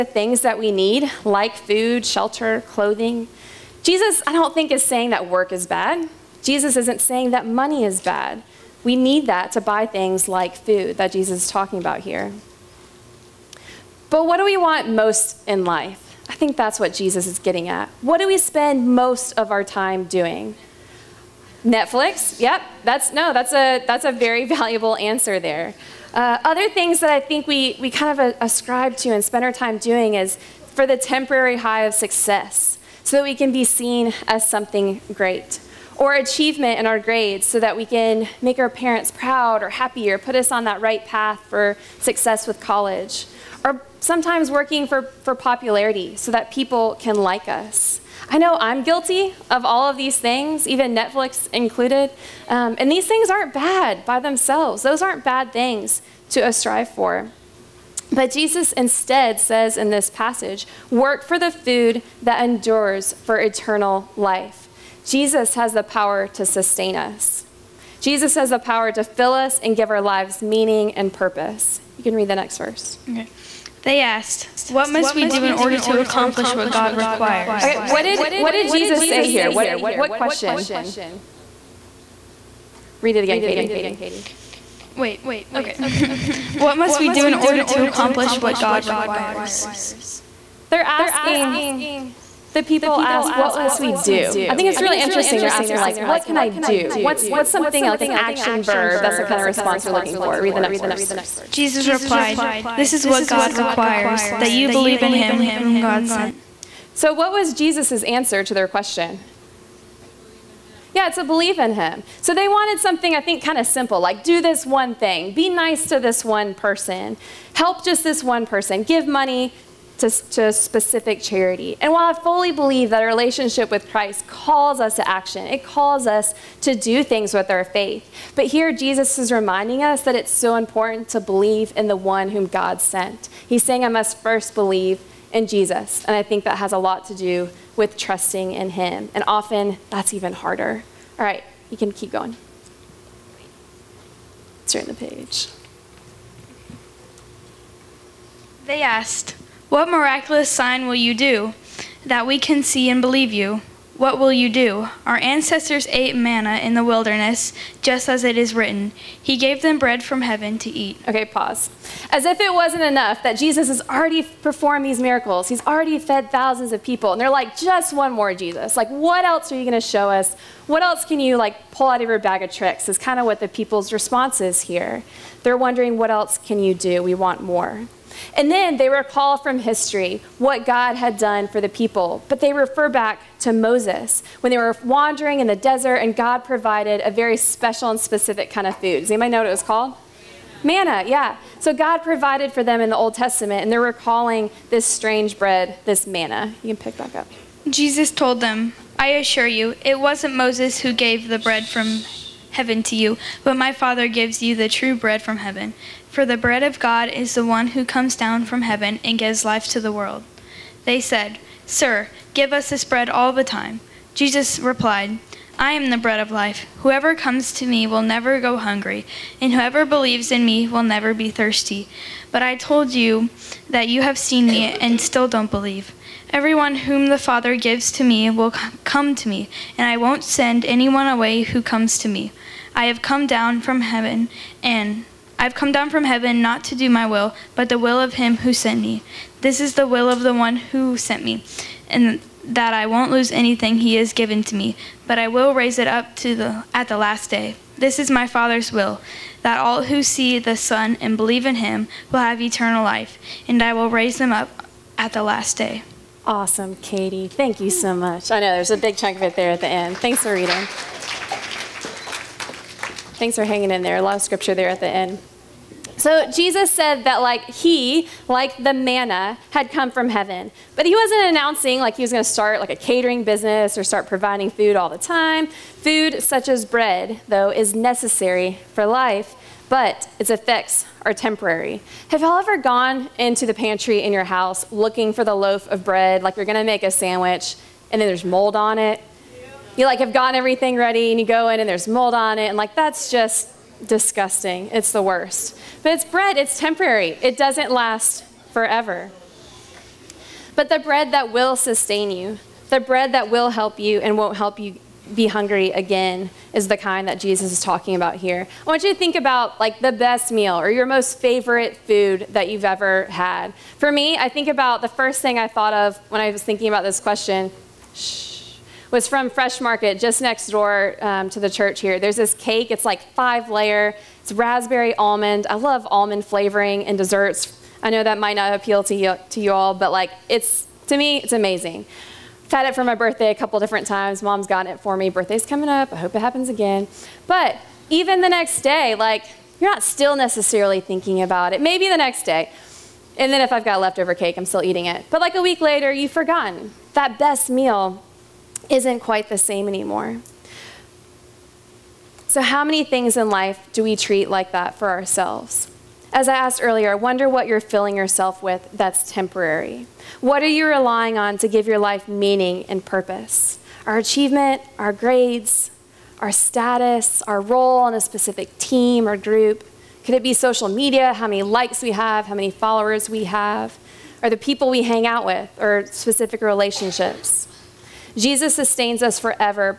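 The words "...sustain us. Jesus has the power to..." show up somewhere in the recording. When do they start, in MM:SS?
01:06.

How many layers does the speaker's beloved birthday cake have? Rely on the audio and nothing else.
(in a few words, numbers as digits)
5.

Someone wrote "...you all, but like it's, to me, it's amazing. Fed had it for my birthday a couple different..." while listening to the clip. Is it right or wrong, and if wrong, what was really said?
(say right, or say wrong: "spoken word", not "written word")
right.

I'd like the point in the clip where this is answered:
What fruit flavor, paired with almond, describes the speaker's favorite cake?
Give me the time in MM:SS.
05:24.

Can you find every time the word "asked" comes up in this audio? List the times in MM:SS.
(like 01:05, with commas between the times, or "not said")
01:14, 02:28, 05:56.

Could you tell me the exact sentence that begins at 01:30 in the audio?
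They're asking, the people ask, what must we do?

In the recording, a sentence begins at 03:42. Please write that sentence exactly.
But I told you that you have seen me and still don't believe.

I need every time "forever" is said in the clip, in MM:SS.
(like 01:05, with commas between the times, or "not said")
04:58, 06:19.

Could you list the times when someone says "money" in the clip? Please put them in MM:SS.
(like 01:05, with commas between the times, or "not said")
00:07, 01:59.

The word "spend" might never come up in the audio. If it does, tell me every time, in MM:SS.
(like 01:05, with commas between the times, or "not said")
00:18, 00:29.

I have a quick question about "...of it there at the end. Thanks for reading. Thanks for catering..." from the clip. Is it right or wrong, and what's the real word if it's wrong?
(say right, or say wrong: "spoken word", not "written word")
wrong: "hanging", not "catering".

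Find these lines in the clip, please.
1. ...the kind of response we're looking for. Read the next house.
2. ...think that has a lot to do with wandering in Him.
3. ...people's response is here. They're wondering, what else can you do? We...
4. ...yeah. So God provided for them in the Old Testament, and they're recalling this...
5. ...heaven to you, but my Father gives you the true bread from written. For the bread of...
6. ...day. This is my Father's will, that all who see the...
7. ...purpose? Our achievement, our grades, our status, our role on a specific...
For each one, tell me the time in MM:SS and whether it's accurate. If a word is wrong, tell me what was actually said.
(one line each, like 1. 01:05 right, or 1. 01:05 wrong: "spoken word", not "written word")
1. 01:39 wrong: "verse", not "house"
2. 02:16 wrong: "trusting", not "wandering"
3. 02:53 right
4. 03:11 right
5. 03:22 wrong: "heaven", not "written"
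6. 04:07 right
7. 06:02 right.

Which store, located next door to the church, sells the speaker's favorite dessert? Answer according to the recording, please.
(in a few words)
Fresh Market.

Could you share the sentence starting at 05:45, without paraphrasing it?
But like a week later, you've forgotten that best meal isn't quite the same anymore.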